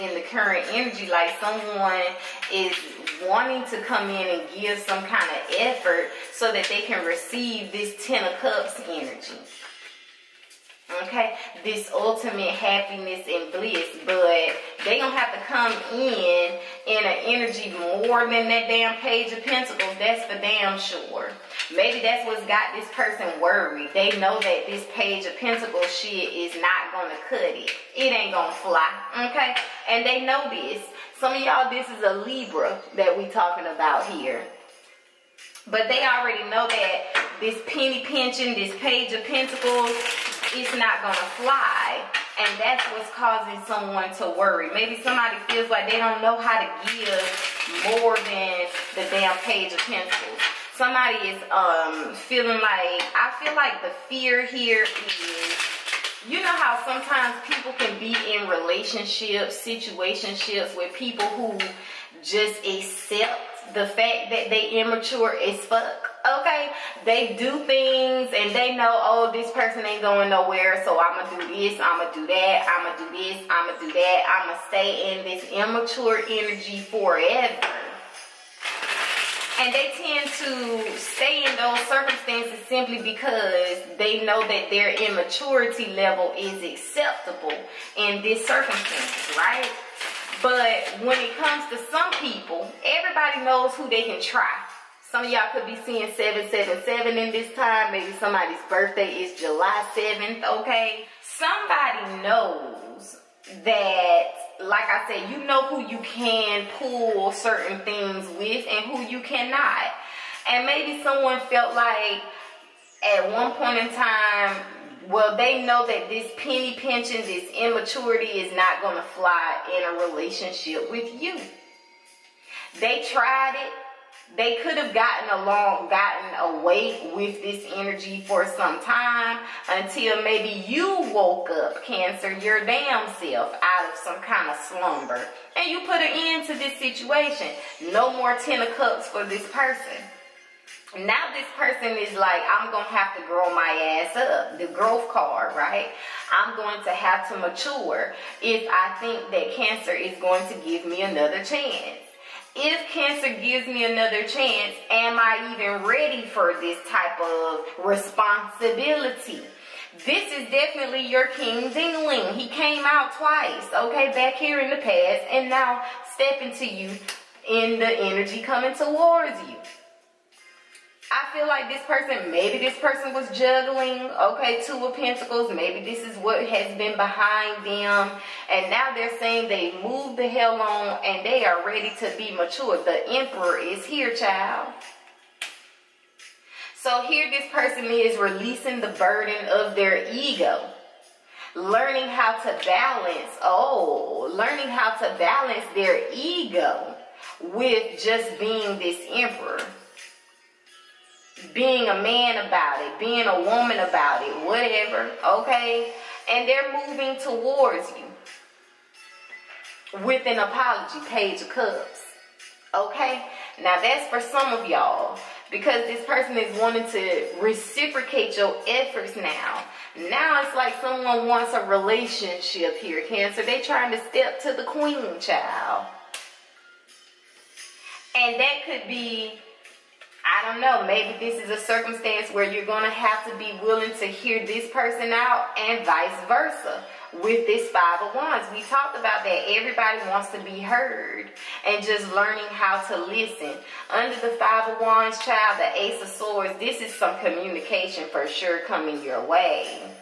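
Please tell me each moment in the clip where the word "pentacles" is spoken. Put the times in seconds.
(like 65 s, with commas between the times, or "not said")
19 s, 25 s, 39 s, 49 s, 174 s.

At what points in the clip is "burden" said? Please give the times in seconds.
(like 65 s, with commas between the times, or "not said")
188 s.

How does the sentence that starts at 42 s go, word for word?
And that's what's causing someone to worry.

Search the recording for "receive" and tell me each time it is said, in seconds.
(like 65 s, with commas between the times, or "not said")
7 s.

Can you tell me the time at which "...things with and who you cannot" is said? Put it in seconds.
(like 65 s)
107 s.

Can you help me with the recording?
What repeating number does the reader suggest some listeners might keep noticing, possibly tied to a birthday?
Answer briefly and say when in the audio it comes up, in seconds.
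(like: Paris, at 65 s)
777, at 96 s.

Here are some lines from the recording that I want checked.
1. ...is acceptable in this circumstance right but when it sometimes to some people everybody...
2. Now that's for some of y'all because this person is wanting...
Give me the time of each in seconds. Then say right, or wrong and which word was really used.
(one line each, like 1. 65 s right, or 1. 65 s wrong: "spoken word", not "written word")
1. 86 s wrong: "comes", not "sometimes"
2. 213 s right.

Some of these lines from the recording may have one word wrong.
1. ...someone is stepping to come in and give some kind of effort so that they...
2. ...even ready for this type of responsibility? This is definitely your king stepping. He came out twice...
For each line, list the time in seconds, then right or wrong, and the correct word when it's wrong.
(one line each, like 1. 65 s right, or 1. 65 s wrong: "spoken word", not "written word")
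1. 1 s wrong: "wanting", not "stepping"
2. 155 s wrong: "dingling", not "stepping".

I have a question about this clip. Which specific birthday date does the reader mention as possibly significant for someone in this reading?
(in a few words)
July 7th.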